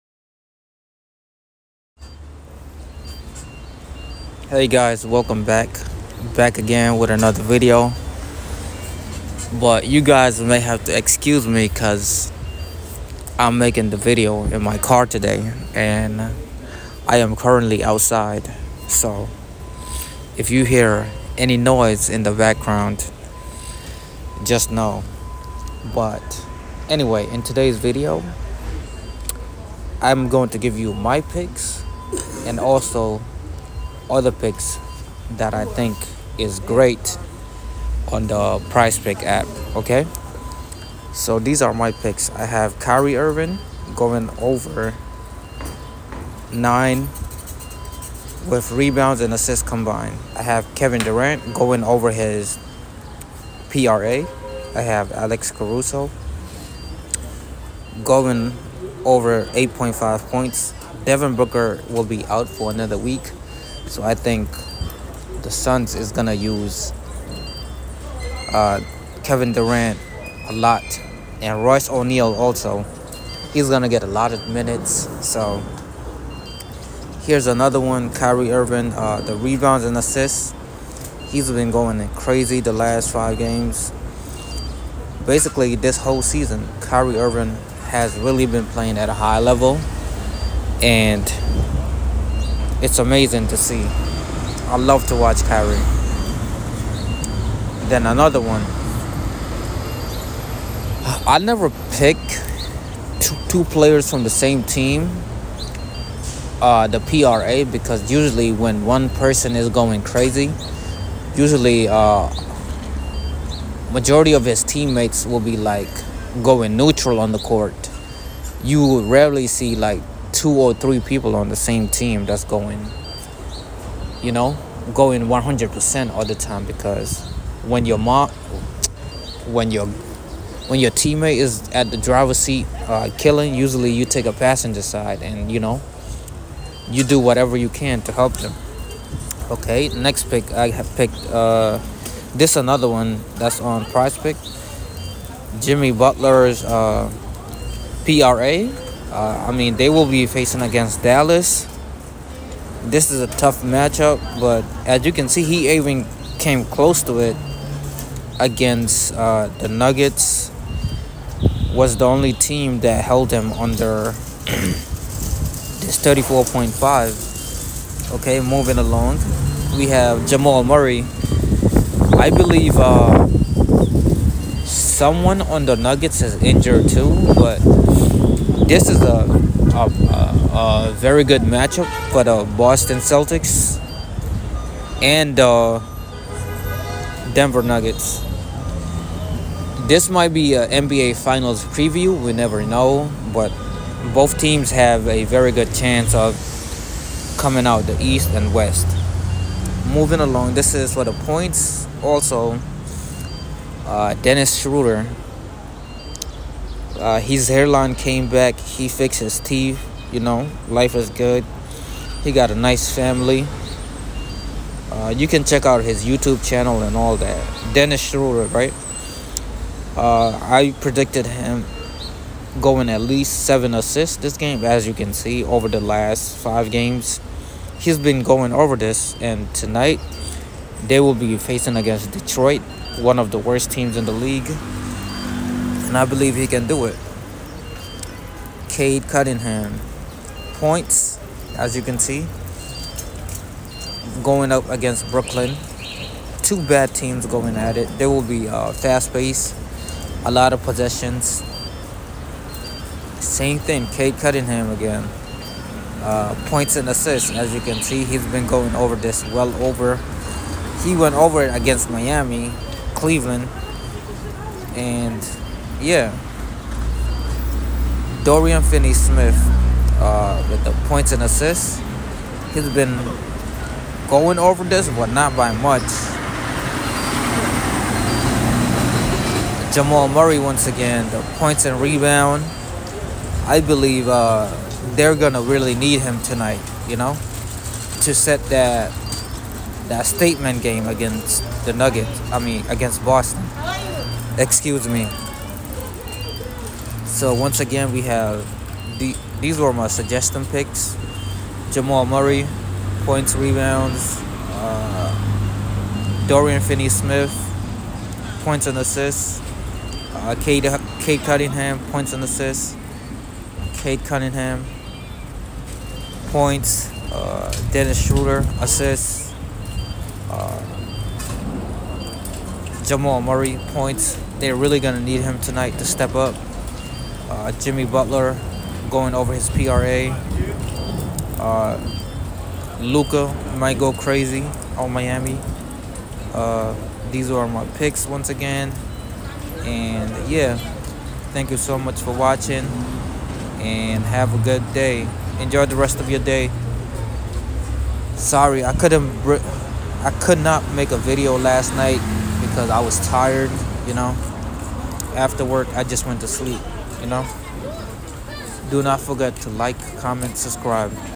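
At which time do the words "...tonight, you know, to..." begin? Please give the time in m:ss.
4:46.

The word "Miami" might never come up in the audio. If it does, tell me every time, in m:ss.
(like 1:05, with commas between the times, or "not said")
4:21, 5:34.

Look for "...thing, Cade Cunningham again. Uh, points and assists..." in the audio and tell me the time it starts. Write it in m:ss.
4:13.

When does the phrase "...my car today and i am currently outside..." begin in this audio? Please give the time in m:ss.
0:14.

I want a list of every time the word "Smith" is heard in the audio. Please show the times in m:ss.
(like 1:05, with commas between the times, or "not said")
4:28, 5:06.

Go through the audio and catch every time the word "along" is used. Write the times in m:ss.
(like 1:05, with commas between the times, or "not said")
2:48, 3:20.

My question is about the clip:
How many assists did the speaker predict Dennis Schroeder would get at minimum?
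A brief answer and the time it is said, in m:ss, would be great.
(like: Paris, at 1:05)
7, at 3:43.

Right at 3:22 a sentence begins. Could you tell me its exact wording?
Also, uh, Dennis Schroeder uh, his hairline came back.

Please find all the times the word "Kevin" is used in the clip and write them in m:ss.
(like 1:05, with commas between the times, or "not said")
0:50, 1:09.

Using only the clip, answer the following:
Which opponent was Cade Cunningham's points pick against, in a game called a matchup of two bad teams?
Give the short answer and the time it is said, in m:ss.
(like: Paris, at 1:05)
Brooklyn, at 4:05.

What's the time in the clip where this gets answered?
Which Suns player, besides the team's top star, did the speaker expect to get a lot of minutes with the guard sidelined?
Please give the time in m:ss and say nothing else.
1:11.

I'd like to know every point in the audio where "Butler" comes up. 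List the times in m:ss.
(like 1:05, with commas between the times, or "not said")
2:25, 5:27.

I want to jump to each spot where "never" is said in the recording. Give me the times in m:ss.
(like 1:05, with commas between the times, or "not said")
1:41, 3:12.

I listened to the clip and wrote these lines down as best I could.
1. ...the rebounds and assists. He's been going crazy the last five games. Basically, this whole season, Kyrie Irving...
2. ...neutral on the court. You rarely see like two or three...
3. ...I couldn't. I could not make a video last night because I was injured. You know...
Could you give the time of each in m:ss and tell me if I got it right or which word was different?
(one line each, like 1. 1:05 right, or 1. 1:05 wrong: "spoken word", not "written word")
1. 1:19 right
2. 1:56 right
3. 5:48 wrong: "tired", not "injured".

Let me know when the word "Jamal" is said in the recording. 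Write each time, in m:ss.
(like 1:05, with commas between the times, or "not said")
2:50, 4:39, 5:01, 5:22.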